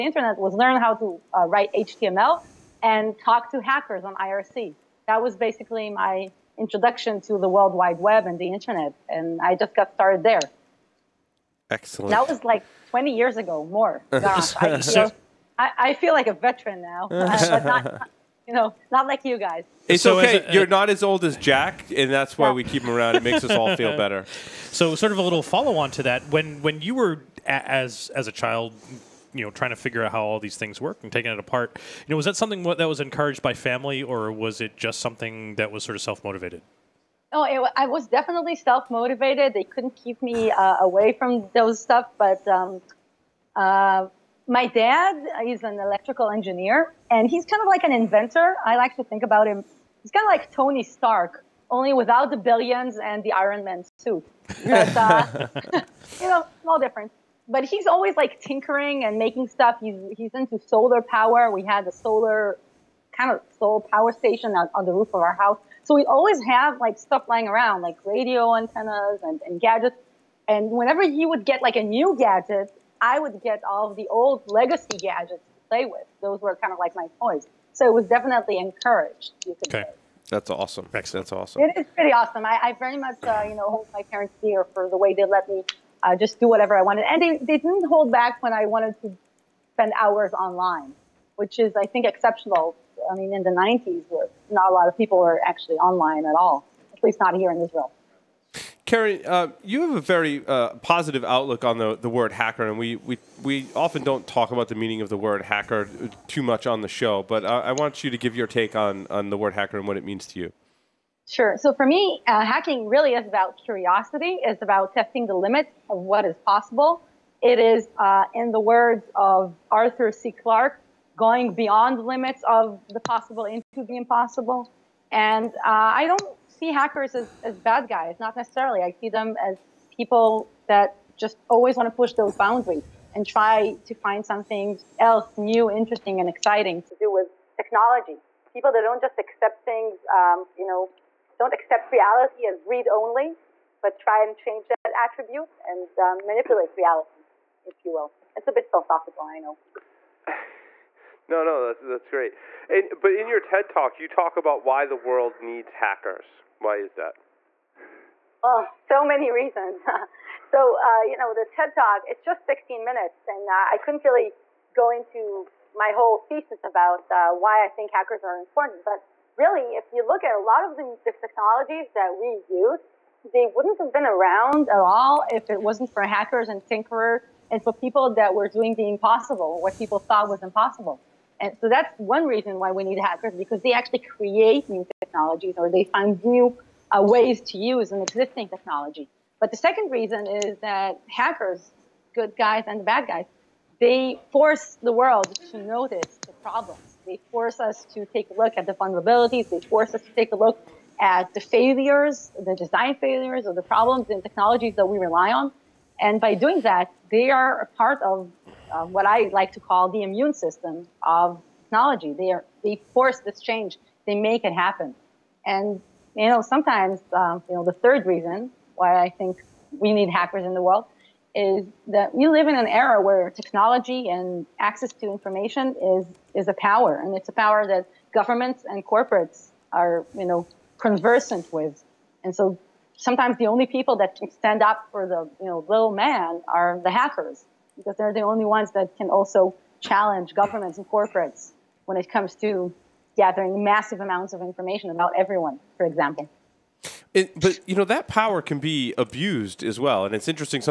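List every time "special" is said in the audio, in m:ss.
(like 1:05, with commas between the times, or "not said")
not said.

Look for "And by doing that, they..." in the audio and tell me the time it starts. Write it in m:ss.
3:26.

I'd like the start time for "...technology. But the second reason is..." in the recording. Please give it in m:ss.
3:08.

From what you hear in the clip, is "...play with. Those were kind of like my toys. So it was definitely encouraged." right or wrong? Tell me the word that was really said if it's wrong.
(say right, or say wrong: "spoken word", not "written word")
right.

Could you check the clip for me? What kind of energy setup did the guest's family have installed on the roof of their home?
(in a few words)
Solar power station.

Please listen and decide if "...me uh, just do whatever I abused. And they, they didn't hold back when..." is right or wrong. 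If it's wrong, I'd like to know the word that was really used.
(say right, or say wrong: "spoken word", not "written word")
wrong: "wanted", not "abused".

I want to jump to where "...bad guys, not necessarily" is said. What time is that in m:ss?
2:07.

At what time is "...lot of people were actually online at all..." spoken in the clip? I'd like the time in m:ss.
1:34.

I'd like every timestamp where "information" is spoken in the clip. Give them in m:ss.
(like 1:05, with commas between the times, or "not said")
3:45, 4:04.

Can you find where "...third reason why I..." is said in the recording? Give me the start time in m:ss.
3:37.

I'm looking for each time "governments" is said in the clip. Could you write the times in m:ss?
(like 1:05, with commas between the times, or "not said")
3:48, 4:00.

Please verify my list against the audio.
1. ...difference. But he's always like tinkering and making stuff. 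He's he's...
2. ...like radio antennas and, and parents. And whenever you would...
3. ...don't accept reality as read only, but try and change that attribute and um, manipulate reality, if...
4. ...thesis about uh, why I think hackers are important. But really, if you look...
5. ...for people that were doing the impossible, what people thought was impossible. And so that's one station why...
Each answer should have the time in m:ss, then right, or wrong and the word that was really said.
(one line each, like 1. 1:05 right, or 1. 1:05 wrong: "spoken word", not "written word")
1. 0:56 right
2. 1:07 wrong: "gadgets", not "parents"
3. 2:21 right
4. 2:46 right
5. 2:57 wrong: "reason", not "station".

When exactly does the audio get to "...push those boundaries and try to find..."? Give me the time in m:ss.
2:11.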